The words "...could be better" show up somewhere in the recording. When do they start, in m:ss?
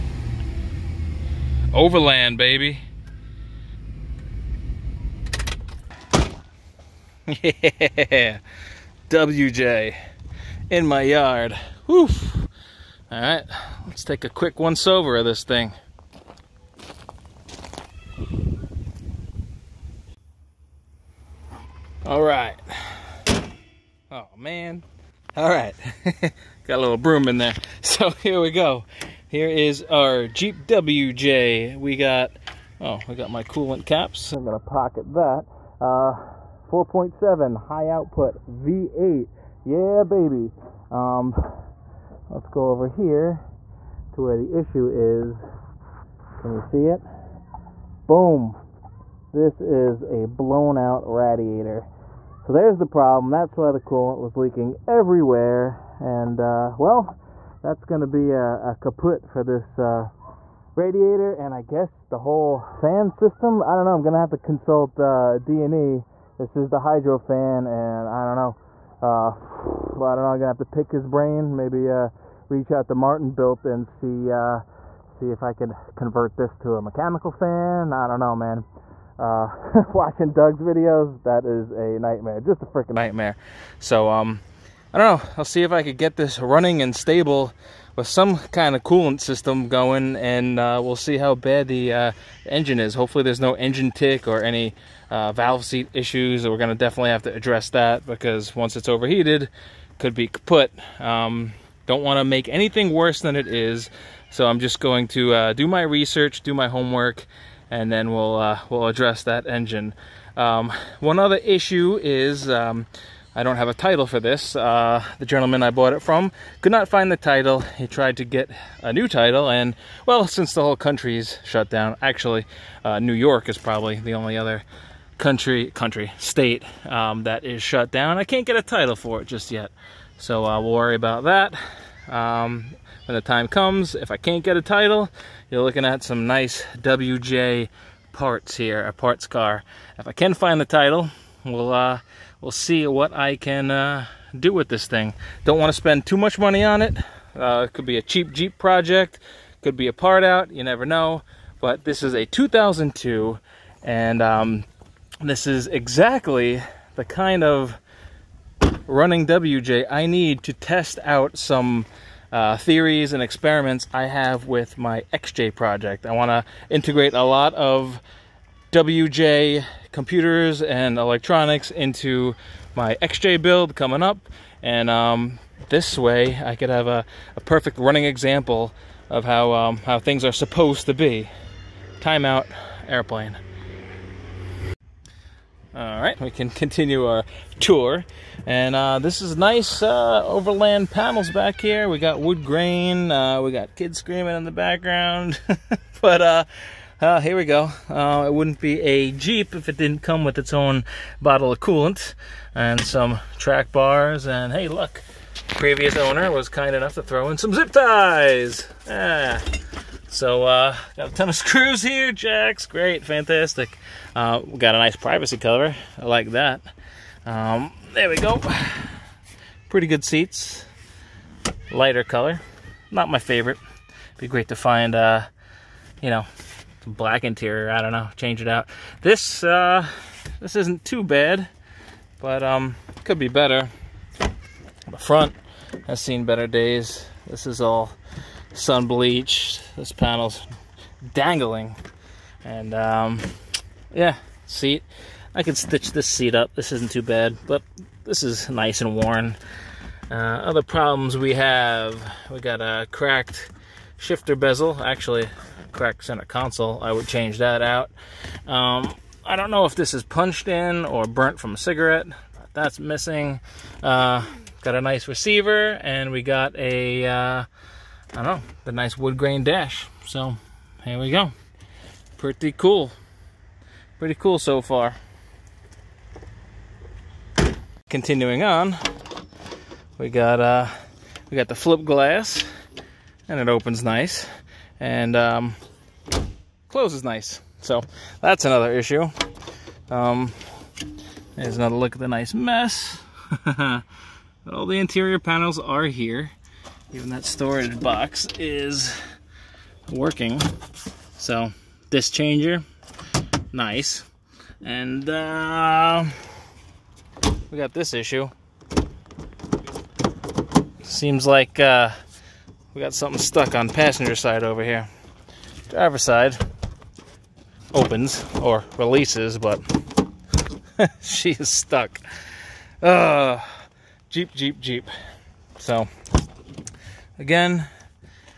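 3:53.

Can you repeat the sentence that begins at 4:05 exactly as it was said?
I could stitch this seat up.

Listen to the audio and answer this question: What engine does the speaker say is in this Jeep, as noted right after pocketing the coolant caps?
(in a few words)
4.7 high output V8.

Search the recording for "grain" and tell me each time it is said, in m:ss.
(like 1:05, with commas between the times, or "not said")
3:12, 4:29.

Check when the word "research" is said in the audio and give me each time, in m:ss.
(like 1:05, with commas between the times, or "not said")
1:45.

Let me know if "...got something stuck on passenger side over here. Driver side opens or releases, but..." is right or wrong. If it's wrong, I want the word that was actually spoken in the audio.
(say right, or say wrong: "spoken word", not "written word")
right.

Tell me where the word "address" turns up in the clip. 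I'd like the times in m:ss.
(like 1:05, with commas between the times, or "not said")
1:37, 1:48.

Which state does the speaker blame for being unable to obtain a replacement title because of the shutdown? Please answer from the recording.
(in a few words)
New York.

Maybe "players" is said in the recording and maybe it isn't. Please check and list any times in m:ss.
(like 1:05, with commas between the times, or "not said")
not said.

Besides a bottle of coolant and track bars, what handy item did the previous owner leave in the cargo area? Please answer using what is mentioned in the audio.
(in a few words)
zip ties.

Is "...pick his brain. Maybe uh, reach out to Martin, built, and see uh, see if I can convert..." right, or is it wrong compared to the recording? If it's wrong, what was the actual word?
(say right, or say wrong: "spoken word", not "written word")
right.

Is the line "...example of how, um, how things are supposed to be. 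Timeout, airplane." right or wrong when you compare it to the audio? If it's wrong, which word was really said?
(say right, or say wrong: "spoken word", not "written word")
right.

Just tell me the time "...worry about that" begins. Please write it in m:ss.
2:10.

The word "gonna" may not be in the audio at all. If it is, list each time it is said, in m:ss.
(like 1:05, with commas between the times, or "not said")
0:34, 1:10.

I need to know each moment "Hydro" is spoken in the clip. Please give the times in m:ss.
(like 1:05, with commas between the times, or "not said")
1:06.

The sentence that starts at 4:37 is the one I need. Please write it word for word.
Continuing on, we got uh, we got the flip glass, and it opens nice, and um, closes nice.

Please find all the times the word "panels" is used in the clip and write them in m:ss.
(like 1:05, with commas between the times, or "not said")
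3:10, 3:59, 4:55.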